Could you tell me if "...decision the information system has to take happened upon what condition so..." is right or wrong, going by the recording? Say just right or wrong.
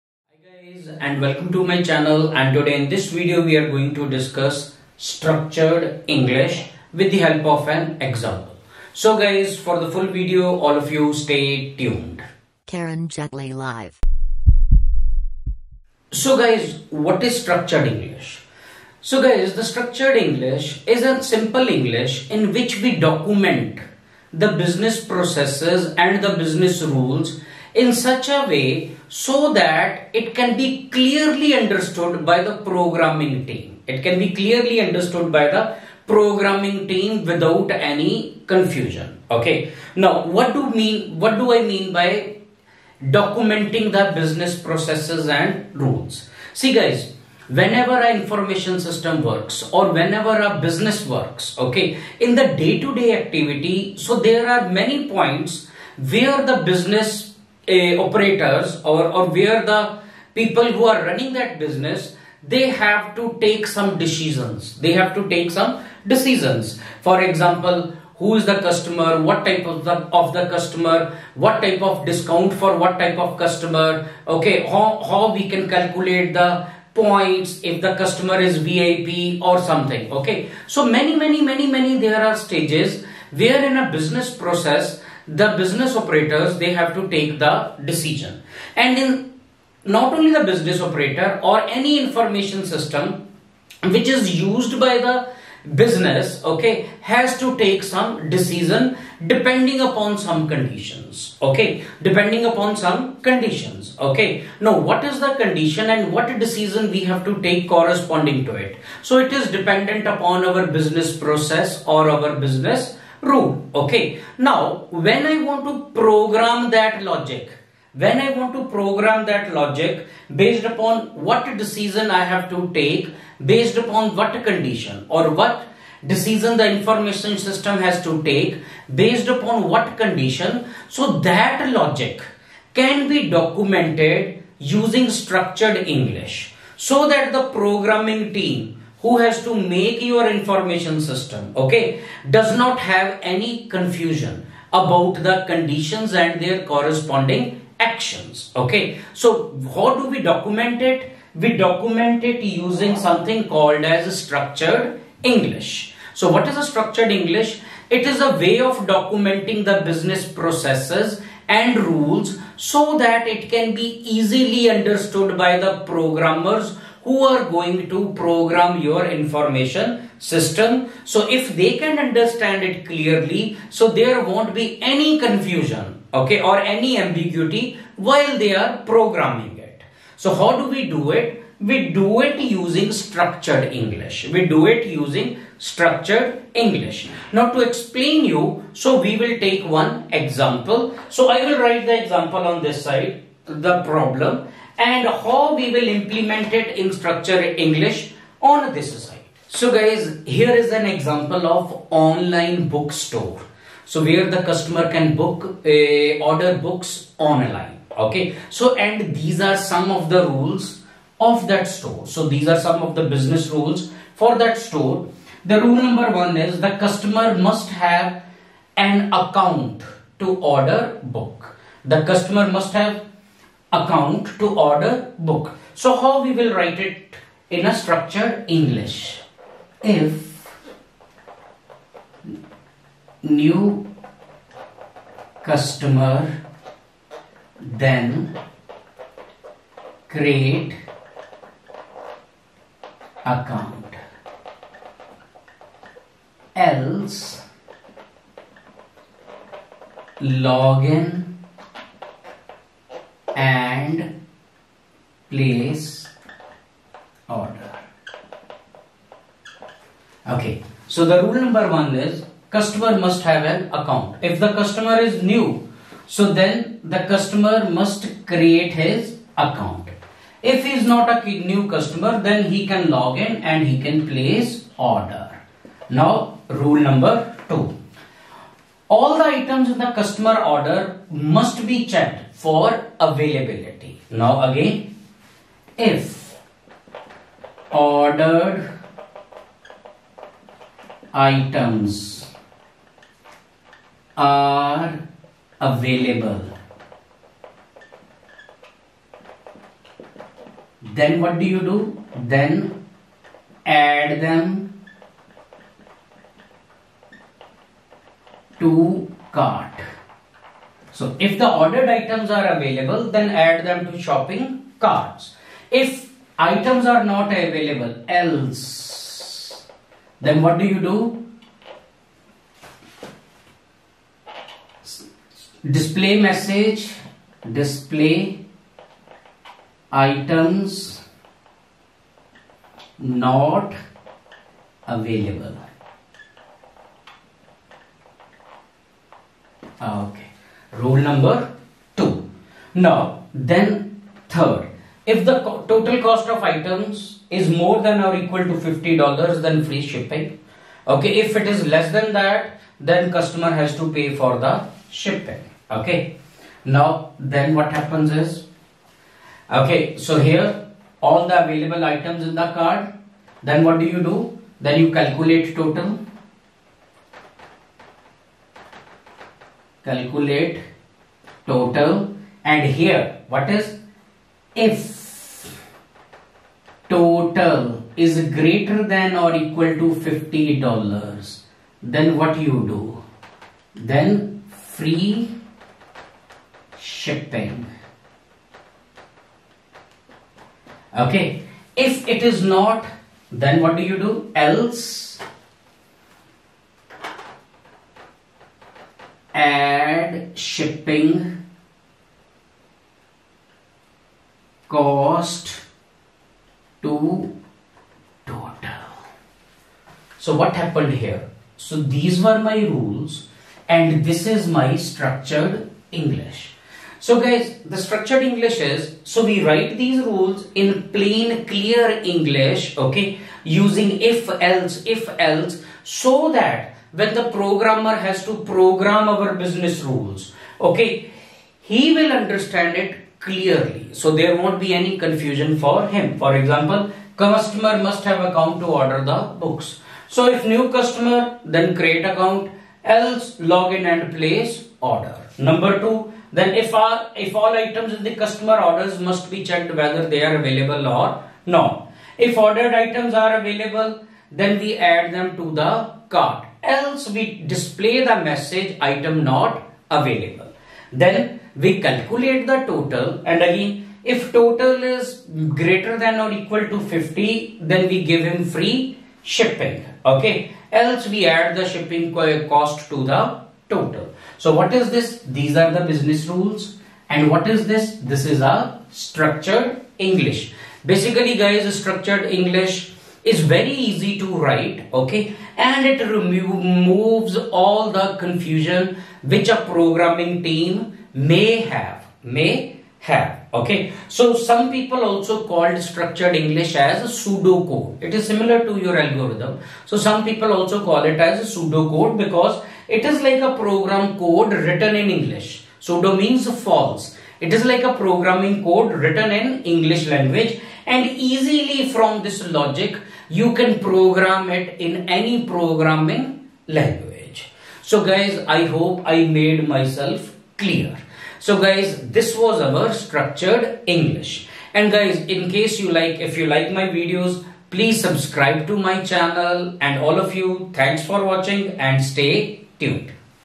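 wrong.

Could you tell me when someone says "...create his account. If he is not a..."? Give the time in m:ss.
4:28.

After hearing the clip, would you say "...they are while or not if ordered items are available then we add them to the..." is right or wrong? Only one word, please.
wrong.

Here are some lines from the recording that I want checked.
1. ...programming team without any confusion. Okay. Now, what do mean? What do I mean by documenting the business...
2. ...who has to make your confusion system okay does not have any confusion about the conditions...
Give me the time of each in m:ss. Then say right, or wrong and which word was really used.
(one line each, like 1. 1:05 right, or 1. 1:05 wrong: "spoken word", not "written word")
1. 0:36 right
2. 2:19 wrong: "information", not "confusion".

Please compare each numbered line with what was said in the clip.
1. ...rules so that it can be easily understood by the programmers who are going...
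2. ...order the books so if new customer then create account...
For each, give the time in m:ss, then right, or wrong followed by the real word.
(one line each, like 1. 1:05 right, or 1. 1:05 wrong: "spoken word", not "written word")
1. 2:41 right
2. 7:18 right.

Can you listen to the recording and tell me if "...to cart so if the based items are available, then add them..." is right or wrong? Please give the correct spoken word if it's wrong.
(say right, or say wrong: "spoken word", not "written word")
wrong: "ordered", not "based".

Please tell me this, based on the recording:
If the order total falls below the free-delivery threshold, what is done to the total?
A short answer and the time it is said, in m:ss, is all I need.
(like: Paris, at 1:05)
Add shipping cost, at 6:39.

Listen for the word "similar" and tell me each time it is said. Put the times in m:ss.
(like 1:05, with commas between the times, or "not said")
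8:18.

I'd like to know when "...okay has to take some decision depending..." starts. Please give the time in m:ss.
1:36.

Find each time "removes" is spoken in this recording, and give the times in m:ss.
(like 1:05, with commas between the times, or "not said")
8:06.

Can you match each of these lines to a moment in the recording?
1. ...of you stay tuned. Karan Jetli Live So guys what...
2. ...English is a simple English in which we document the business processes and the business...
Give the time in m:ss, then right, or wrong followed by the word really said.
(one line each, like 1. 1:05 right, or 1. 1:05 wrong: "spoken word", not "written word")
1. 0:10 right
2. 0:20 right.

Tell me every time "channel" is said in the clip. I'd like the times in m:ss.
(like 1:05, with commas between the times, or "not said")
0:01, 8:49.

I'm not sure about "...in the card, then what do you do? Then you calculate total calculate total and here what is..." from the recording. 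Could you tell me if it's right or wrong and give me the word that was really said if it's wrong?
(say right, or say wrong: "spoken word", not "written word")
right.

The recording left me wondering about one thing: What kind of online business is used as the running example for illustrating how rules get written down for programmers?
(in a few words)
Online bookstore.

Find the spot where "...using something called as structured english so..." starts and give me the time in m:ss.
2:32.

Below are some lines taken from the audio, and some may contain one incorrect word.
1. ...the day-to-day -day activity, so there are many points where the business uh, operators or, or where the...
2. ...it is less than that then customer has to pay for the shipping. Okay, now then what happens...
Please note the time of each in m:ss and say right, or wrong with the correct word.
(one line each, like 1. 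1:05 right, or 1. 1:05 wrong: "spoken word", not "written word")
1. 0:52 right
2. 5:51 right.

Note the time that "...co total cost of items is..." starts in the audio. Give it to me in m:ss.
5:45.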